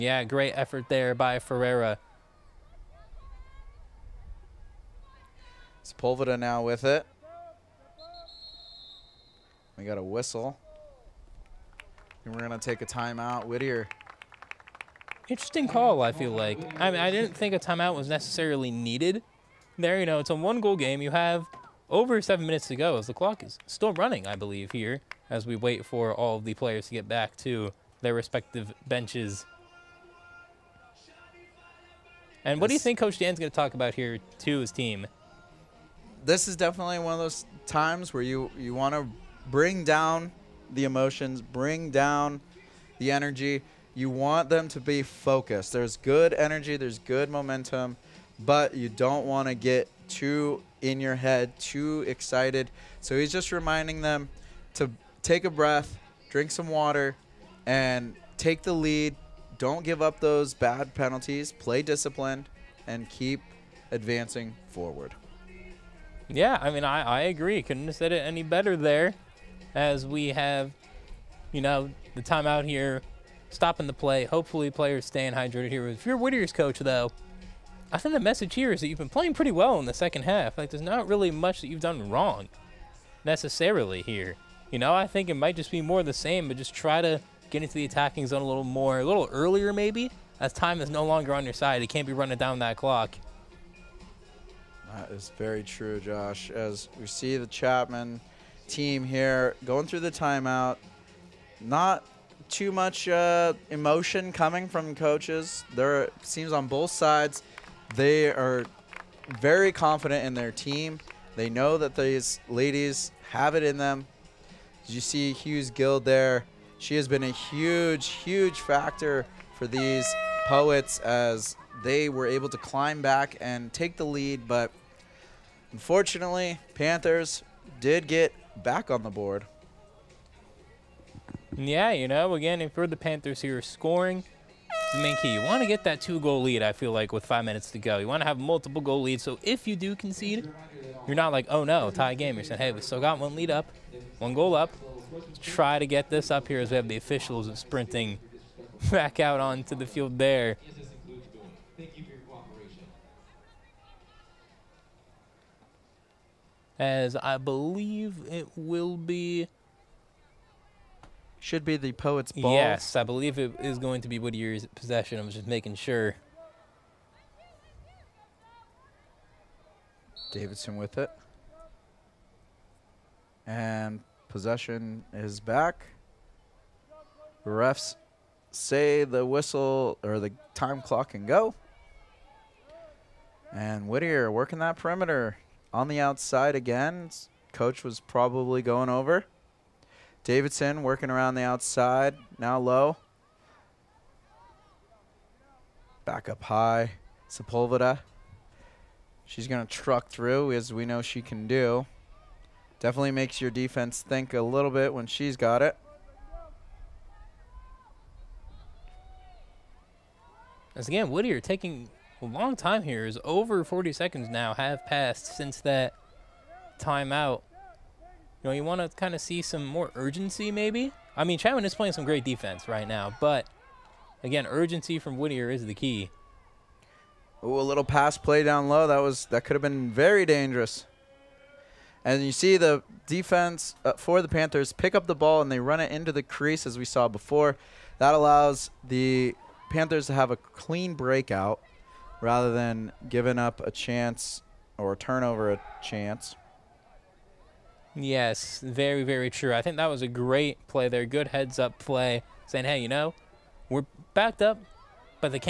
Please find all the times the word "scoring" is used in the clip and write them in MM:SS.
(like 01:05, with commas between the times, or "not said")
02:13.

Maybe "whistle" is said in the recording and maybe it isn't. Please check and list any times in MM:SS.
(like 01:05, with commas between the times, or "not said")
00:10, 02:59.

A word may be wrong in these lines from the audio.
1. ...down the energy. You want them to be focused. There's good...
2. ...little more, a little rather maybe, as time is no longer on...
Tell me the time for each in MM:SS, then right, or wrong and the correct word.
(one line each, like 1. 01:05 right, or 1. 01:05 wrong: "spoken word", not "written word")
1. 00:41 right
2. 01:28 wrong: "earlier", not "rather".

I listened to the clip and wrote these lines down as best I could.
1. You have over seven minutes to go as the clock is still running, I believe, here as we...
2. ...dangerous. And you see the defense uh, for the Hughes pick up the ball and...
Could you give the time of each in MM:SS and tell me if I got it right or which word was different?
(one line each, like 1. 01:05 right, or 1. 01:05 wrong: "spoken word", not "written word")
1. 00:20 right
2. 03:50 wrong: "Panthers", not "Hughes".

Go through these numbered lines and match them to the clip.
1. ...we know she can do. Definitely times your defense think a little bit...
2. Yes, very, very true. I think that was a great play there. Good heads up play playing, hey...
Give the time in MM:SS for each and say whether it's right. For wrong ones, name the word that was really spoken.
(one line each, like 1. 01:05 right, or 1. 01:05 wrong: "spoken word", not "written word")
1. 03:20 wrong: "makes", not "times"
2. 04:08 wrong: "saying", not "playing".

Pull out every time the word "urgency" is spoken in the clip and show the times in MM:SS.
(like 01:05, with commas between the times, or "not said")
03:39, 03:44.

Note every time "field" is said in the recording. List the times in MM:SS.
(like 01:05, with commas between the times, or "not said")
02:29.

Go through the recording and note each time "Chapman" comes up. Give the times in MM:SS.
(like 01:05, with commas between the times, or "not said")
01:37, 03:41.